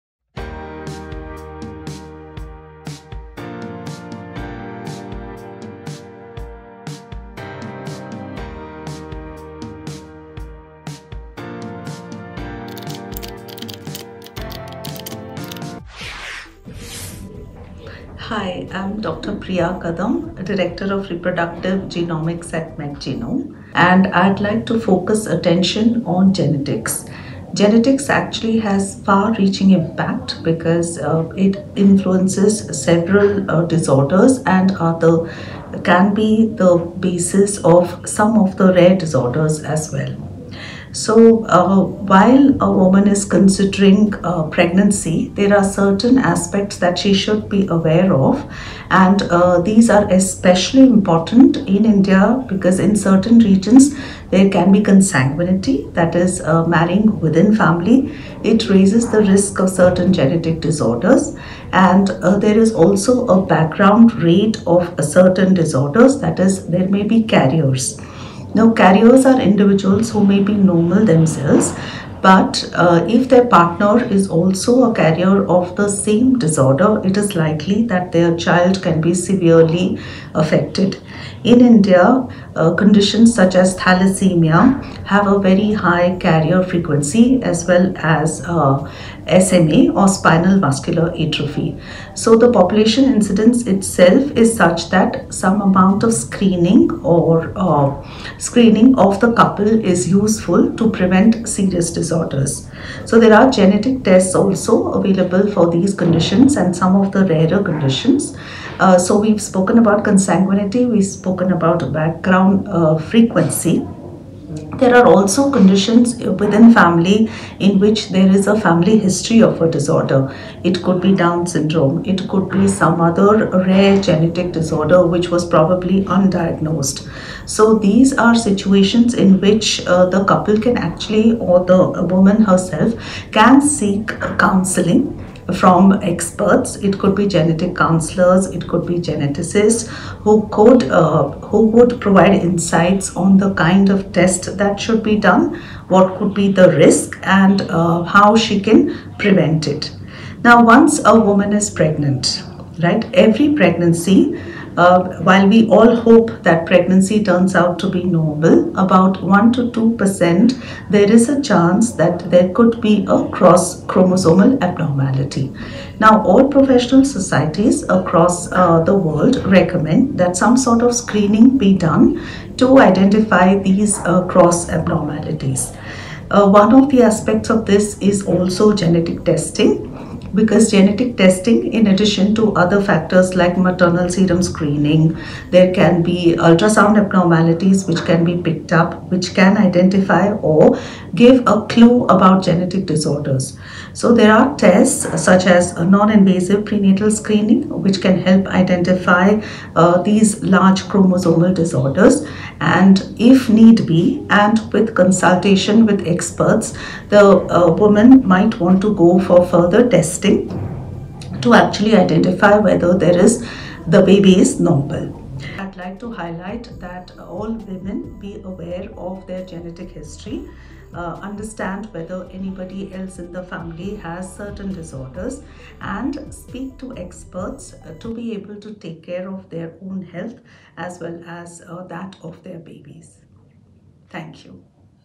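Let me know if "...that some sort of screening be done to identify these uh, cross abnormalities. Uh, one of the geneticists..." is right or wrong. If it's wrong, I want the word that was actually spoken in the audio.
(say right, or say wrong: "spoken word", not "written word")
wrong: "aspects", not "geneticists".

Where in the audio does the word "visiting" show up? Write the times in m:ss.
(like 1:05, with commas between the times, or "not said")
not said.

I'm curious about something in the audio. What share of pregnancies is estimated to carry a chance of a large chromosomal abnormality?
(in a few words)
1 to 2%.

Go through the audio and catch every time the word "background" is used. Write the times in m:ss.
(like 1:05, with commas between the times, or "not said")
1:03, 1:51.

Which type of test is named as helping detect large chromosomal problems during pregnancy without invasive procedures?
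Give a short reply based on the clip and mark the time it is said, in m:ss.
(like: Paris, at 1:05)
non-invasive prenatal screening, at 3:15.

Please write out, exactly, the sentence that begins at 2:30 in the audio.
Now, once a woman is pregnant, right?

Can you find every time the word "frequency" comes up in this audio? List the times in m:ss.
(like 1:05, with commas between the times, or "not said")
1:26, 1:52.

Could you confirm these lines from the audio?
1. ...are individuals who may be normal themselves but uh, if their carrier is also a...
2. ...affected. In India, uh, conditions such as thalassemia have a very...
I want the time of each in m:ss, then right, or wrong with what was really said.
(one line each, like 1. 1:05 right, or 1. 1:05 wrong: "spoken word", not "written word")
1. 1:09 wrong: "partner", not "carrier"
2. 1:20 right.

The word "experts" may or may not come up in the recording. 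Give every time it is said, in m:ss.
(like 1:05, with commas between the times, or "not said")
2:16, 3:26, 3:46.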